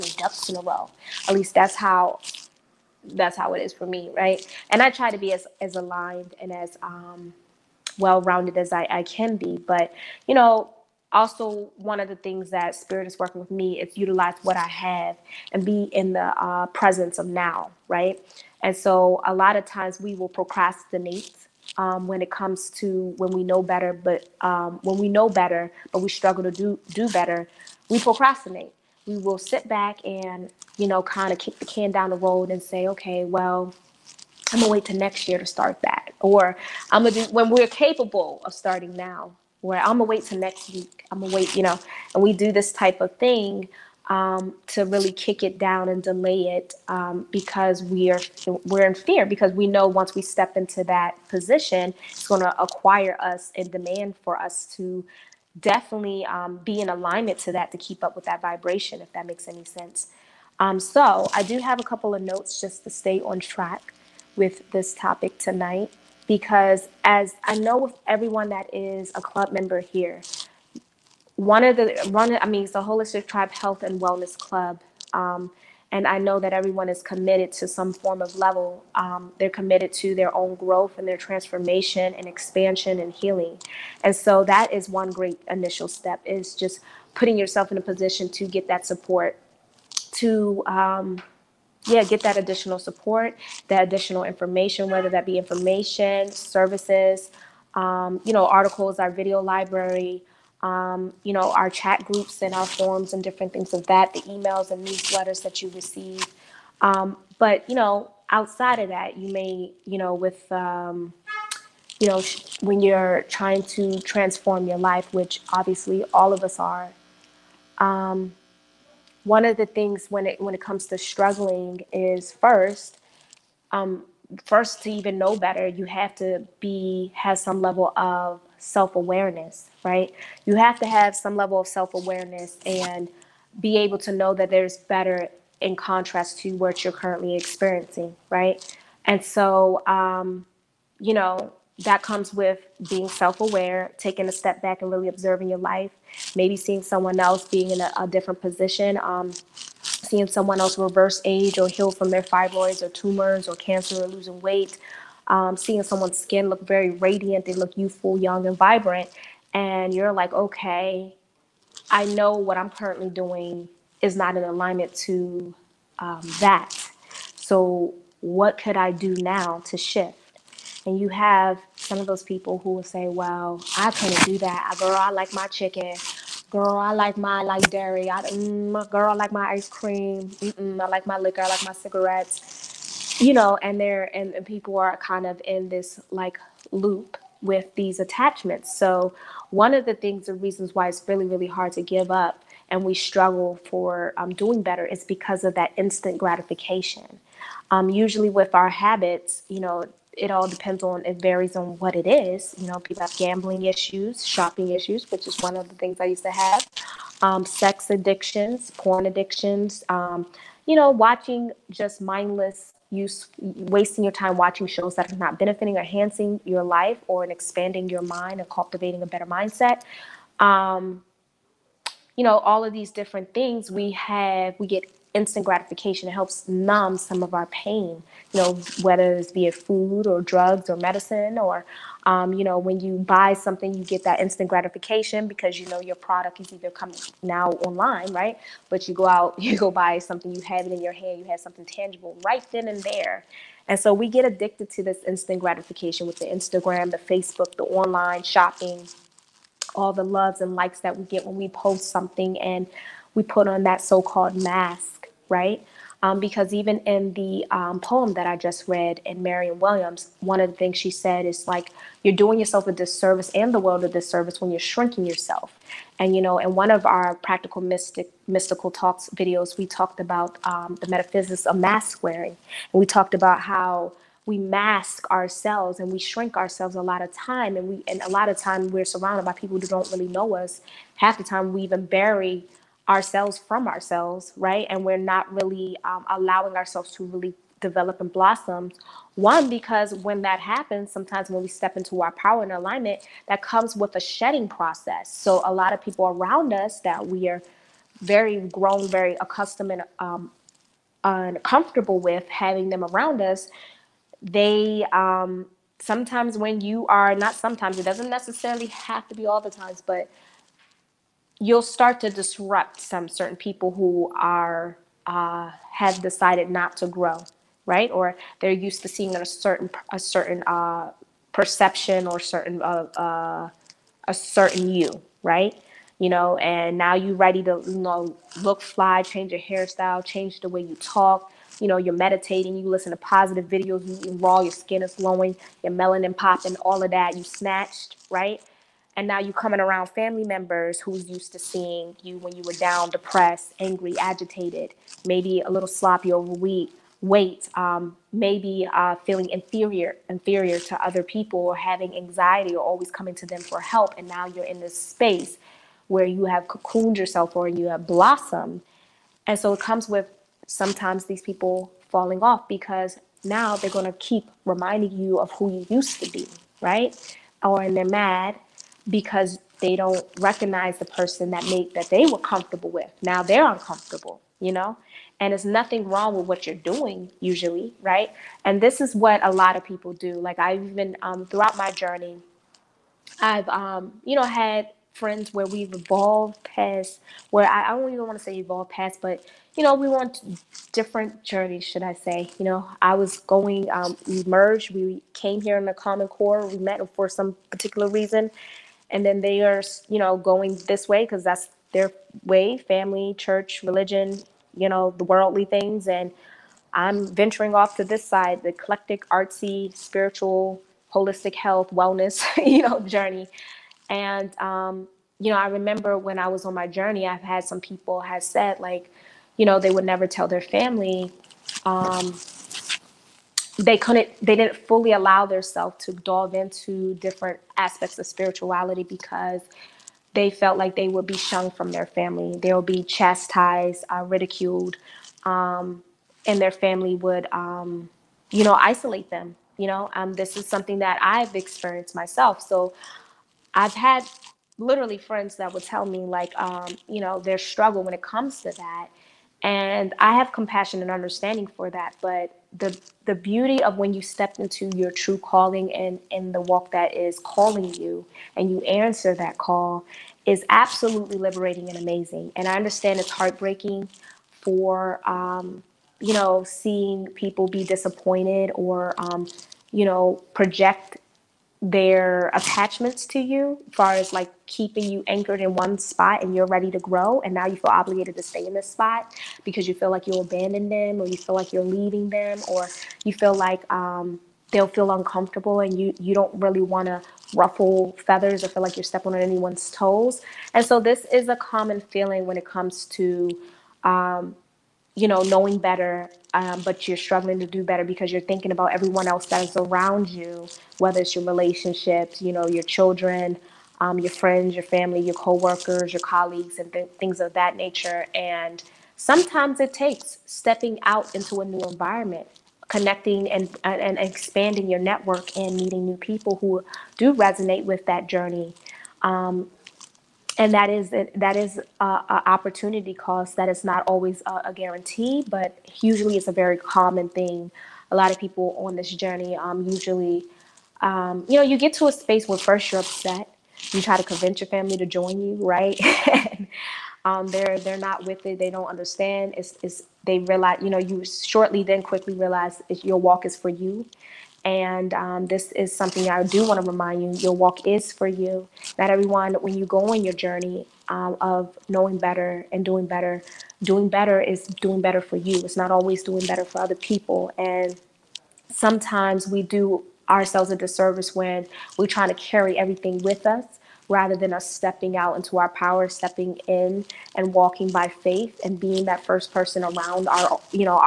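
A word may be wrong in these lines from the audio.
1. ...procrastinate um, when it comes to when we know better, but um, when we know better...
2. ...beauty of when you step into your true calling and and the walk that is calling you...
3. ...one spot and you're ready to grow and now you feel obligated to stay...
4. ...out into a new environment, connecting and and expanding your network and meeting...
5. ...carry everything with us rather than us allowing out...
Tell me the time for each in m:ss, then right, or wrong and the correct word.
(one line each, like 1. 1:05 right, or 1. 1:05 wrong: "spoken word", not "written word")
1. 0:20 right
2. 7:33 right
3. 7:55 right
4. 8:30 right
5. 9:22 wrong: "stepping", not "allowing".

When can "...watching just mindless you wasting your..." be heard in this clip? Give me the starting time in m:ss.
3:30.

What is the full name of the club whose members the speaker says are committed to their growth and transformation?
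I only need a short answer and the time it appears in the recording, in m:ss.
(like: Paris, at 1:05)
Holistic Tribe Health and Wellness Club, at 1:12.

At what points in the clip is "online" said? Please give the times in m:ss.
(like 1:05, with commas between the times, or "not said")
3:57, 4:07.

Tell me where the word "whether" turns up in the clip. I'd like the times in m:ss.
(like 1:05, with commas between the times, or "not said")
1:34, 3:48, 8:20.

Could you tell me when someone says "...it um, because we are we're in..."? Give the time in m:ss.
0:46.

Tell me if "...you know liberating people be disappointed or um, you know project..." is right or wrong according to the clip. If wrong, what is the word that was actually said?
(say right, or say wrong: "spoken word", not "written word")
wrong: "seeing", not "liberating".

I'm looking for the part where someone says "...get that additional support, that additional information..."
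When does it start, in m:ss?
1:32.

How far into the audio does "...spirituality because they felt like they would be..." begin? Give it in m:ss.
7:08.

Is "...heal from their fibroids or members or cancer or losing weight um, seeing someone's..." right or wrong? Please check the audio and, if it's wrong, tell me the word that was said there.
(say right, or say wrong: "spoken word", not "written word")
wrong: "tumors", not "members".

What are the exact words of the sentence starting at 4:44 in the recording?
And we're not really um, allowing ourselves to really develop and blossom.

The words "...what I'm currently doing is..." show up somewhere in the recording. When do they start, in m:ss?
2:42.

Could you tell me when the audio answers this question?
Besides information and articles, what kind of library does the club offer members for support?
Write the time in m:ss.
1:39.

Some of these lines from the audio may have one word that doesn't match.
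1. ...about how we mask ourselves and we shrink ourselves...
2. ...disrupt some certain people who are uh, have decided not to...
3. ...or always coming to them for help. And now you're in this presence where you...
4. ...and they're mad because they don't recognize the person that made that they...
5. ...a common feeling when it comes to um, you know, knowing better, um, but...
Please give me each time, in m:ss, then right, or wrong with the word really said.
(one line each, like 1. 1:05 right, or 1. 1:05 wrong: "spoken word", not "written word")
1. 4:33 right
2. 5:12 right
3. 5:52 wrong: "space", not "presence"
4. 6:07 right
5. 8:11 right.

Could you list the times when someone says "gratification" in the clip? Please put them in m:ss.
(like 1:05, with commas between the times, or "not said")
3:16, 3:45, 3:54, 4:05.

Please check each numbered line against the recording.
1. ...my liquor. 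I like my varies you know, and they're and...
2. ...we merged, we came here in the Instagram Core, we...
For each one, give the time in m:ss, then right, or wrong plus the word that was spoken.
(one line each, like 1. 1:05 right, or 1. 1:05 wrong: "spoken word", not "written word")
1. 3:01 wrong: "cigarettes", not "varies"
2. 6:34 wrong: "Common", not "Instagram".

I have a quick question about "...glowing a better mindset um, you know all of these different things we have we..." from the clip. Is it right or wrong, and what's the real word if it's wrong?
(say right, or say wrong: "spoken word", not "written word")
wrong: "cultivating", not "glowing".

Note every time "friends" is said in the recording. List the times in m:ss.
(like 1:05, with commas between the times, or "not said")
6:24, 7:24, 8:24.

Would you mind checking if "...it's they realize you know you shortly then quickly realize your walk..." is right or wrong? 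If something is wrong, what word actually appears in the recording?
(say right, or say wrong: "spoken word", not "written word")
right.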